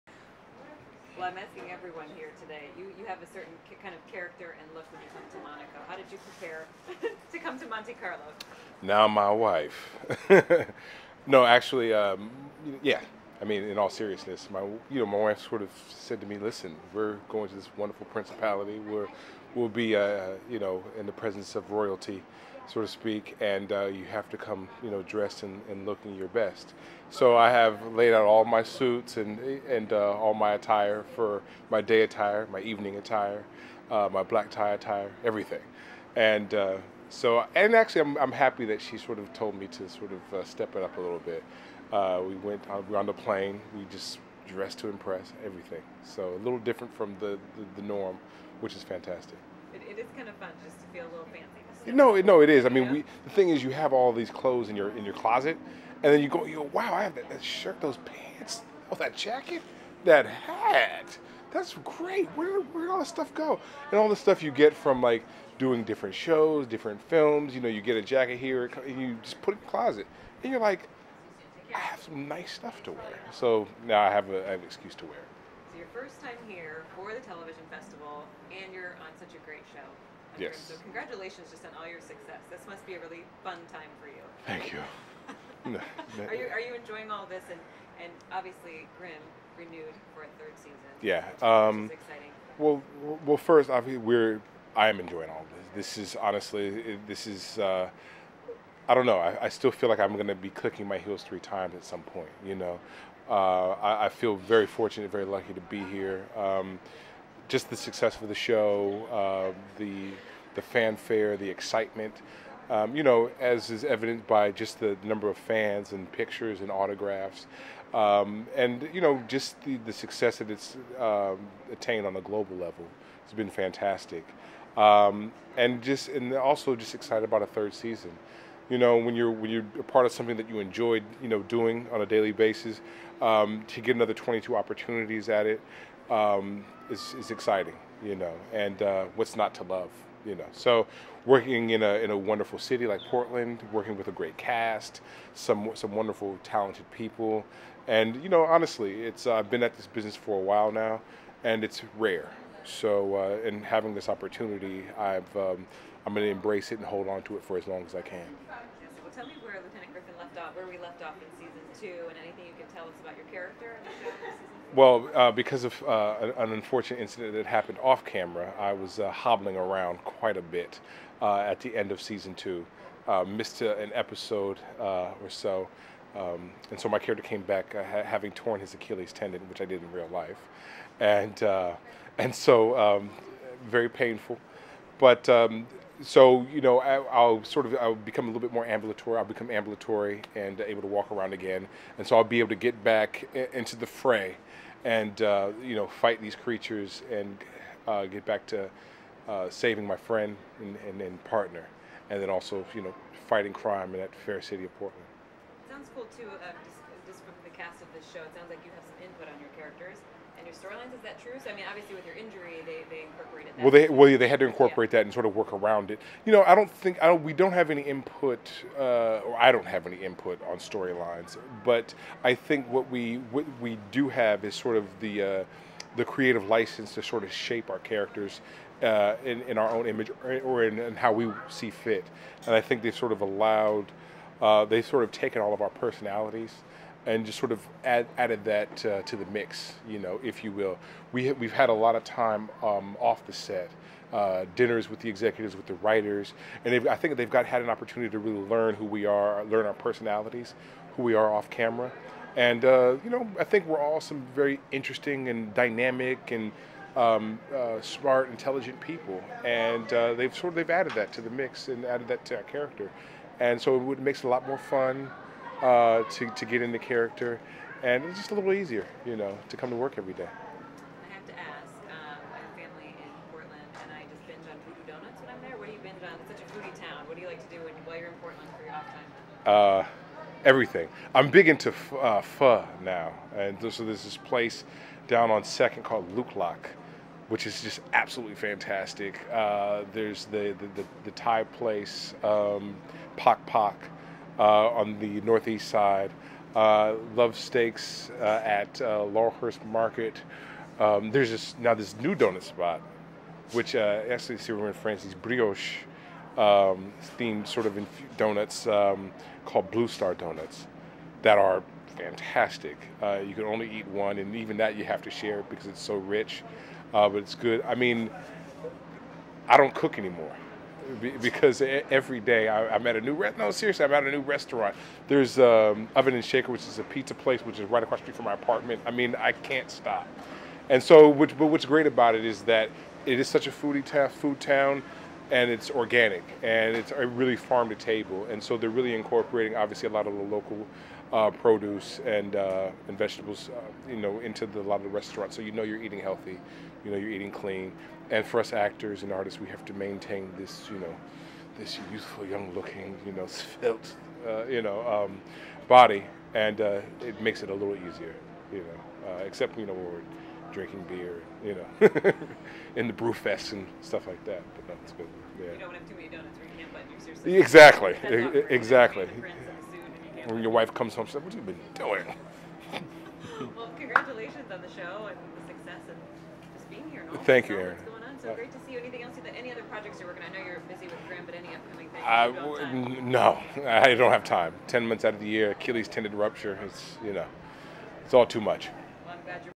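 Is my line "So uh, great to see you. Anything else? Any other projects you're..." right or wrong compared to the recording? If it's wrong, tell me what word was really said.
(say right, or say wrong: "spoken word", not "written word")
right.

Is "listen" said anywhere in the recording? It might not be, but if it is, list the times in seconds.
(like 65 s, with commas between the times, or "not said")
16 s.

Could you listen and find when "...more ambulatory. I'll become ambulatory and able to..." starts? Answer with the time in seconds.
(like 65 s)
188 s.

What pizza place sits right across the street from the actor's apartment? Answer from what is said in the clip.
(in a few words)
Oven and Shaker.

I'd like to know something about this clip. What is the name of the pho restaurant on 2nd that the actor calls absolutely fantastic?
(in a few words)
Luc Lac.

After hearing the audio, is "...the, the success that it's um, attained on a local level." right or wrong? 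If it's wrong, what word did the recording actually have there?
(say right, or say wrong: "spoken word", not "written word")
wrong: "global", not "local".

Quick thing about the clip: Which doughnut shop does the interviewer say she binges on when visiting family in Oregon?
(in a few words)
Voodoo Donuts.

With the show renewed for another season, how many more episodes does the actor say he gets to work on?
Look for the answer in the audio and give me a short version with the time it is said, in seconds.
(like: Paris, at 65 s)
22, at 134 s.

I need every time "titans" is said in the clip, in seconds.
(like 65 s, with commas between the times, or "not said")
not said.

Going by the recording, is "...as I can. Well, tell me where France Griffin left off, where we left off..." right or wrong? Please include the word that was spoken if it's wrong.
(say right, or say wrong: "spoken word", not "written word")
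wrong: "Lieutenant", not "France".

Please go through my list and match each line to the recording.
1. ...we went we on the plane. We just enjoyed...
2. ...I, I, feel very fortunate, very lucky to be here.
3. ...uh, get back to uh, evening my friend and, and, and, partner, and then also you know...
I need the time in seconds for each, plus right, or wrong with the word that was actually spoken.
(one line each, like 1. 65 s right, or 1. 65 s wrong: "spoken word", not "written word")
1. 42 s wrong: "dressed", not "enjoyed"
2. 103 s right
3. 197 s wrong: "saving", not "evening".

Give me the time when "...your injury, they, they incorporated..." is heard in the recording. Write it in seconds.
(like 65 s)
212 s.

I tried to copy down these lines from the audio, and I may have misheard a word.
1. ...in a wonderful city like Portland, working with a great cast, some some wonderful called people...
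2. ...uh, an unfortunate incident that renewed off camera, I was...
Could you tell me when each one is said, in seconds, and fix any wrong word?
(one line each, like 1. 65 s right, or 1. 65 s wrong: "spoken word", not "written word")
1. 141 s wrong: "talented", not "called"
2. 165 s wrong: "happened", not "renewed".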